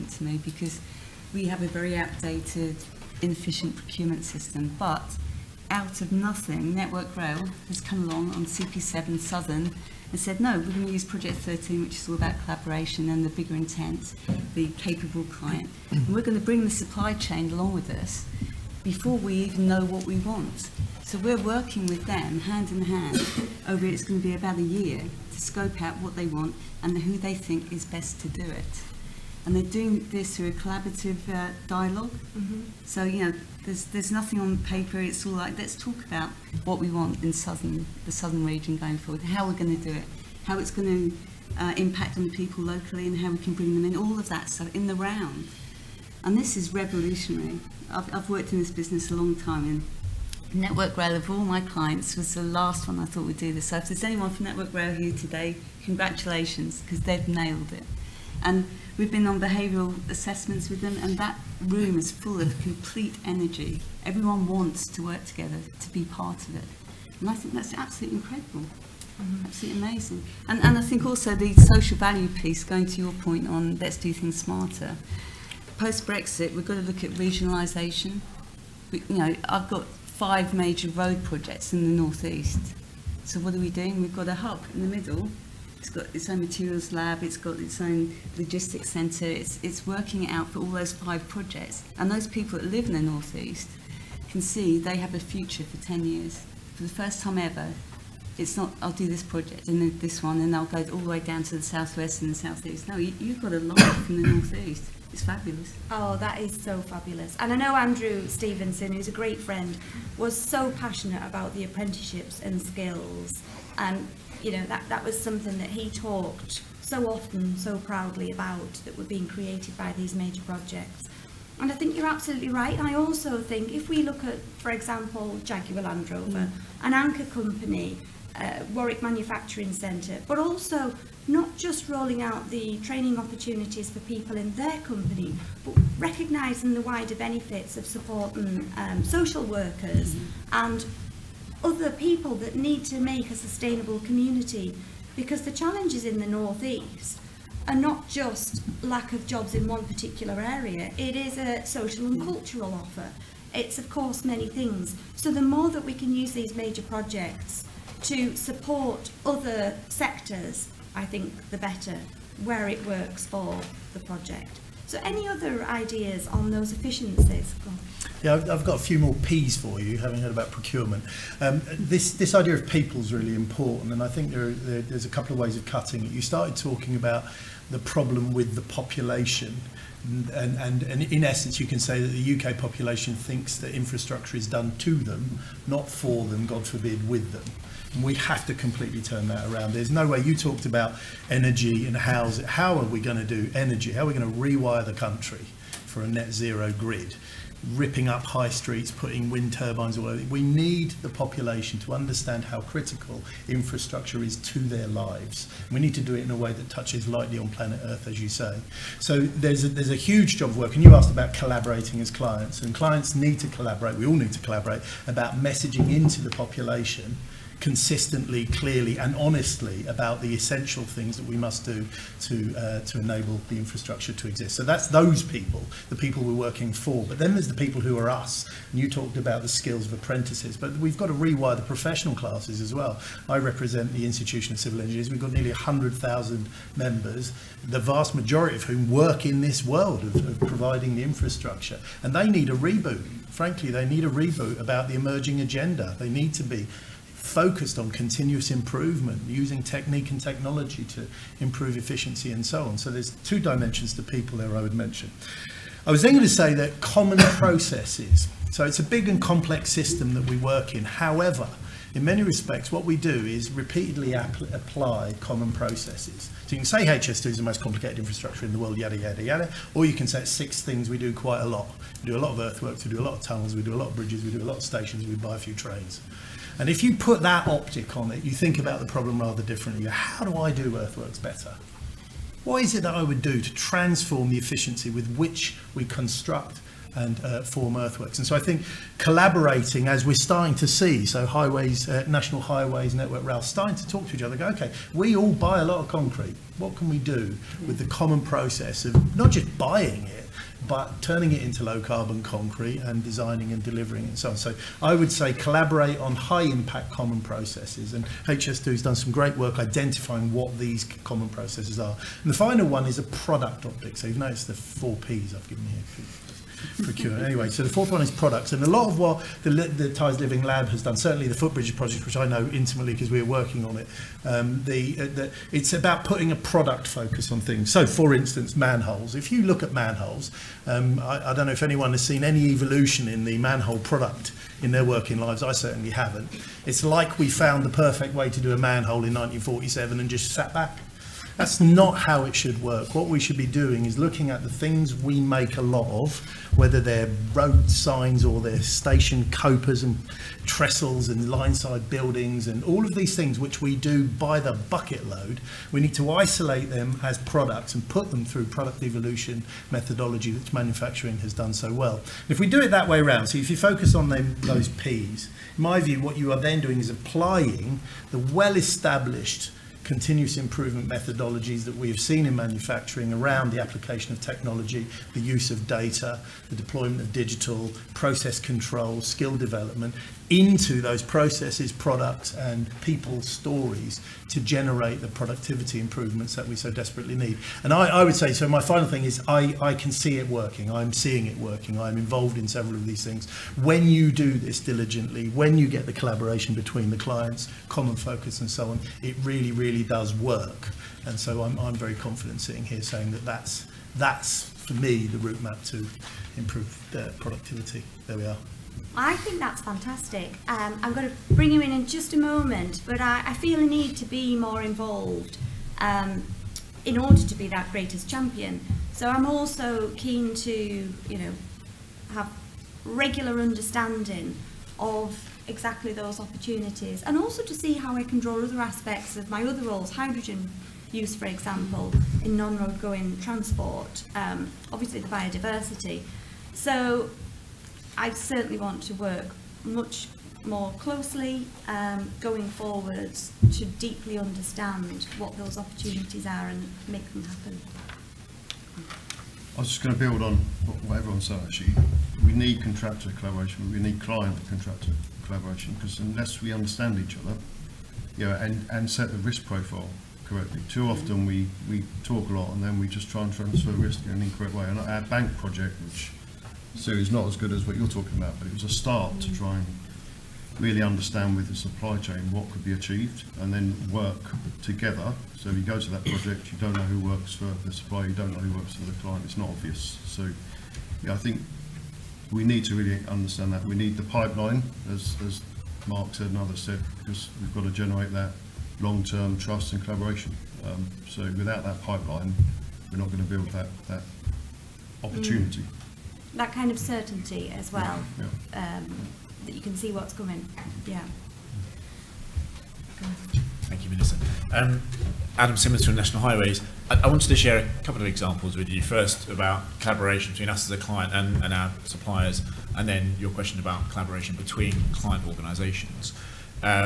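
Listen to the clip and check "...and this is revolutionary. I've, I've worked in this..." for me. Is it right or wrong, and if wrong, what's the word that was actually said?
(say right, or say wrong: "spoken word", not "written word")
right.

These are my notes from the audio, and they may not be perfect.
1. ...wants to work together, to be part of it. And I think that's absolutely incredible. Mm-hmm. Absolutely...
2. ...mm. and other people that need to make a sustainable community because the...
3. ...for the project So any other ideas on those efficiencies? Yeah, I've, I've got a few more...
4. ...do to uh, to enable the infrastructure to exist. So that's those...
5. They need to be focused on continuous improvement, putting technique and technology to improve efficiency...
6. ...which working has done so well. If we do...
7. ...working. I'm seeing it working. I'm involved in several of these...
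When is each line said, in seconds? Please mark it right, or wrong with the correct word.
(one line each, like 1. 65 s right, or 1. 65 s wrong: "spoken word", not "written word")
1. 64 s right
2. 140 s right
3. 163 s right
4. 221 s right
5. 245 s wrong: "using", not "putting"
6. 360 s wrong: "manufacturing", not "working"
7. 390 s right.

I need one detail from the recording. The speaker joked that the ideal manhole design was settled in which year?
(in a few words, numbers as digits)
1947.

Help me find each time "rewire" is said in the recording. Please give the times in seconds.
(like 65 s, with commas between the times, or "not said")
194 s, 231 s.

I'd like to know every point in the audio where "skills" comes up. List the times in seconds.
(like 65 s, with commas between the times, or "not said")
112 s, 229 s, 379 s.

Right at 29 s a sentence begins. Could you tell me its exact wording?
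and they're doing this through a collaborative uh, dialog mm -hmm.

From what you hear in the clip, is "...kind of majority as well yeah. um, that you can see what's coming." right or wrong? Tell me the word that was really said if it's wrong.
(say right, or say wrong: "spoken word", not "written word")
wrong: "certainty", not "majority".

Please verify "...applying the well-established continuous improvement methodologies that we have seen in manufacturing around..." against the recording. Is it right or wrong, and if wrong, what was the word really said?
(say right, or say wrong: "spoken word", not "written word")
right.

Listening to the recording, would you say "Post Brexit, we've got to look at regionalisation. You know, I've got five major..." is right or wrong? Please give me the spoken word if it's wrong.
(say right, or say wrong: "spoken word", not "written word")
right.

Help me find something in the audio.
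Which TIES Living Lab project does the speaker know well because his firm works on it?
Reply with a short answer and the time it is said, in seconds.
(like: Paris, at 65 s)
Footbridge project, at 321 s.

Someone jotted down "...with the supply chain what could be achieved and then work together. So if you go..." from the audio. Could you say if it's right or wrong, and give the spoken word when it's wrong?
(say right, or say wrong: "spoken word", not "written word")
right.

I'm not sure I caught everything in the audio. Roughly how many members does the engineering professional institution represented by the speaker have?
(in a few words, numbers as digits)
100,000.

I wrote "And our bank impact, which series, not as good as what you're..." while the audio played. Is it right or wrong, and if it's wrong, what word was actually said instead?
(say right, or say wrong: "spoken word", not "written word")
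wrong: "project", not "impact".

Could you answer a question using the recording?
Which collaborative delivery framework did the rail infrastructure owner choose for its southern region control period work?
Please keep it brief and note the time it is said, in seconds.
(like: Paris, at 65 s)
Project 13, at 11 s.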